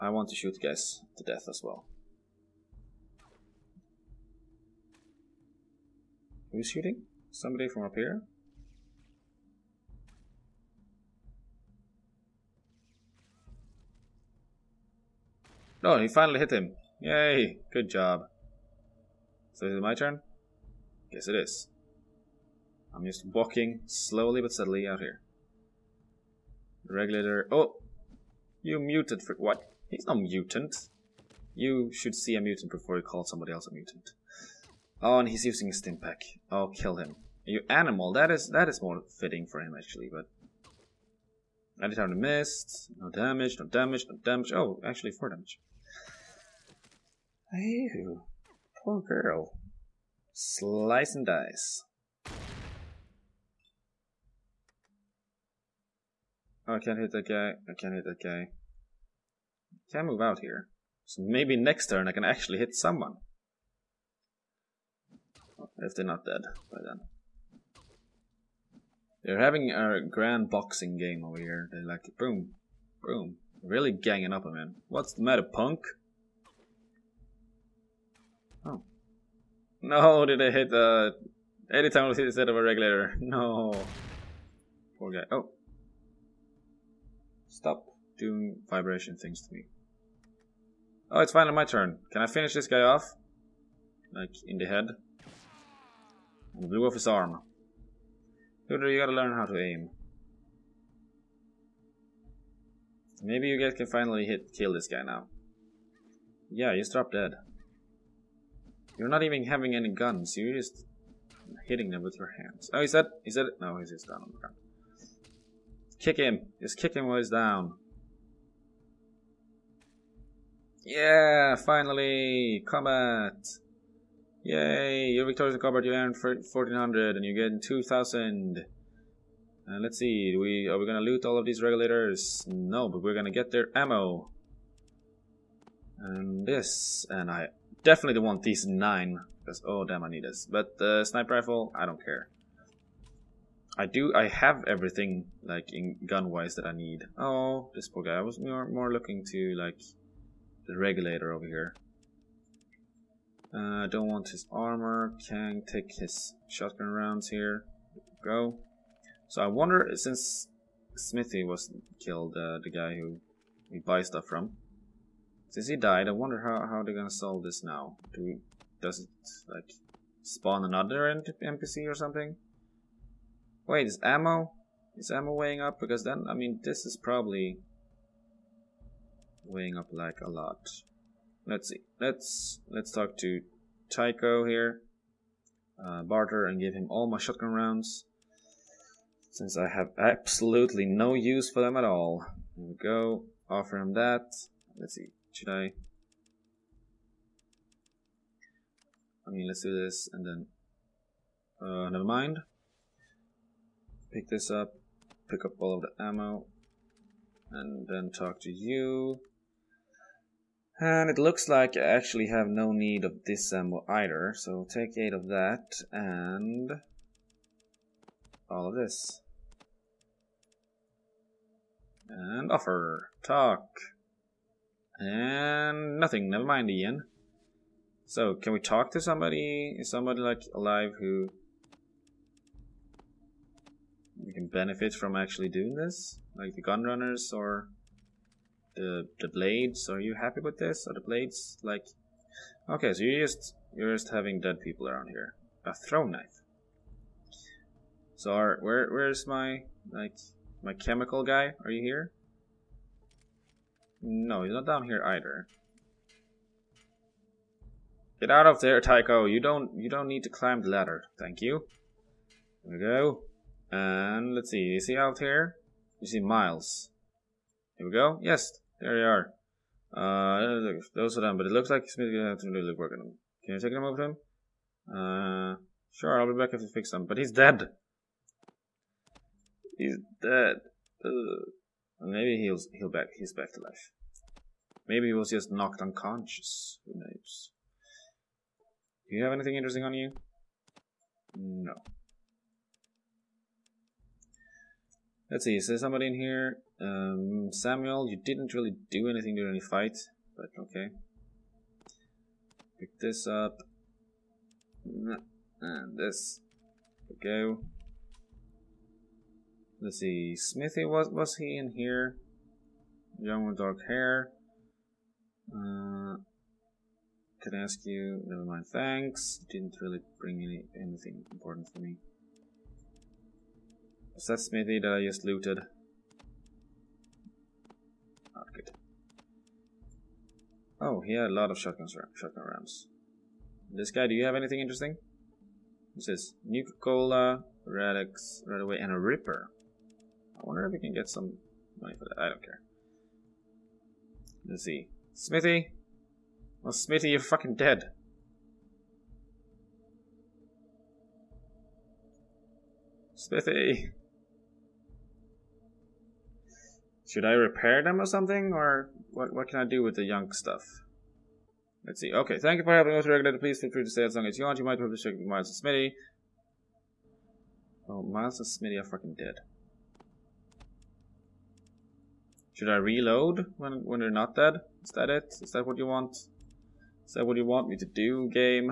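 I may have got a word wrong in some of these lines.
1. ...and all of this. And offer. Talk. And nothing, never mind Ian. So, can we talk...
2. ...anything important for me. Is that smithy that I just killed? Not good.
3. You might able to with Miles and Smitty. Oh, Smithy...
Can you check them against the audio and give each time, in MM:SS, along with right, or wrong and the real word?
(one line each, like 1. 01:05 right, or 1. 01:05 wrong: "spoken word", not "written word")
1. 03:35 right
2. 05:20 wrong: "looted", not "killed"
3. 06:04 wrong: "Miles", not "Smithy".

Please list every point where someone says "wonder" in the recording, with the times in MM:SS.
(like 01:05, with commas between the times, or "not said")
02:39, 02:46, 05:40.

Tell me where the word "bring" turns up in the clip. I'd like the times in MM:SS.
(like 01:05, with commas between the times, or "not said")
05:20.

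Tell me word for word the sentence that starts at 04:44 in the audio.
Maybe he was just knocked unconscious.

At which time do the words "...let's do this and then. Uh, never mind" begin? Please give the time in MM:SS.
03:19.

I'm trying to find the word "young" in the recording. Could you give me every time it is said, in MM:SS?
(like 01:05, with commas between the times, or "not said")
05:13, 06:00.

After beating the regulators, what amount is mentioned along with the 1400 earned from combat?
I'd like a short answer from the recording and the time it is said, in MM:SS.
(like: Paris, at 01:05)
2000, at 02:07.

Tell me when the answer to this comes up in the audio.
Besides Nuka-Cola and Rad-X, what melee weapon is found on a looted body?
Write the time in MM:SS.
05:38.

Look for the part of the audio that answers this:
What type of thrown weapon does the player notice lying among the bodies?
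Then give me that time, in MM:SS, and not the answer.
04:05.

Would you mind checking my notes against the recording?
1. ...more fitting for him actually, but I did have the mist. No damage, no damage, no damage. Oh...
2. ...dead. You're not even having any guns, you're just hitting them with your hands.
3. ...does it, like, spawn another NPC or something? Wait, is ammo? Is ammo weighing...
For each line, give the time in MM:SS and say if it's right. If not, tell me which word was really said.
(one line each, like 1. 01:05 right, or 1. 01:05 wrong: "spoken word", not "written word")
1. 00:38 right
2. 01:47 right
3. 02:48 right.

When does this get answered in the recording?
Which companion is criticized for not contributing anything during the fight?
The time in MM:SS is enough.
04:57.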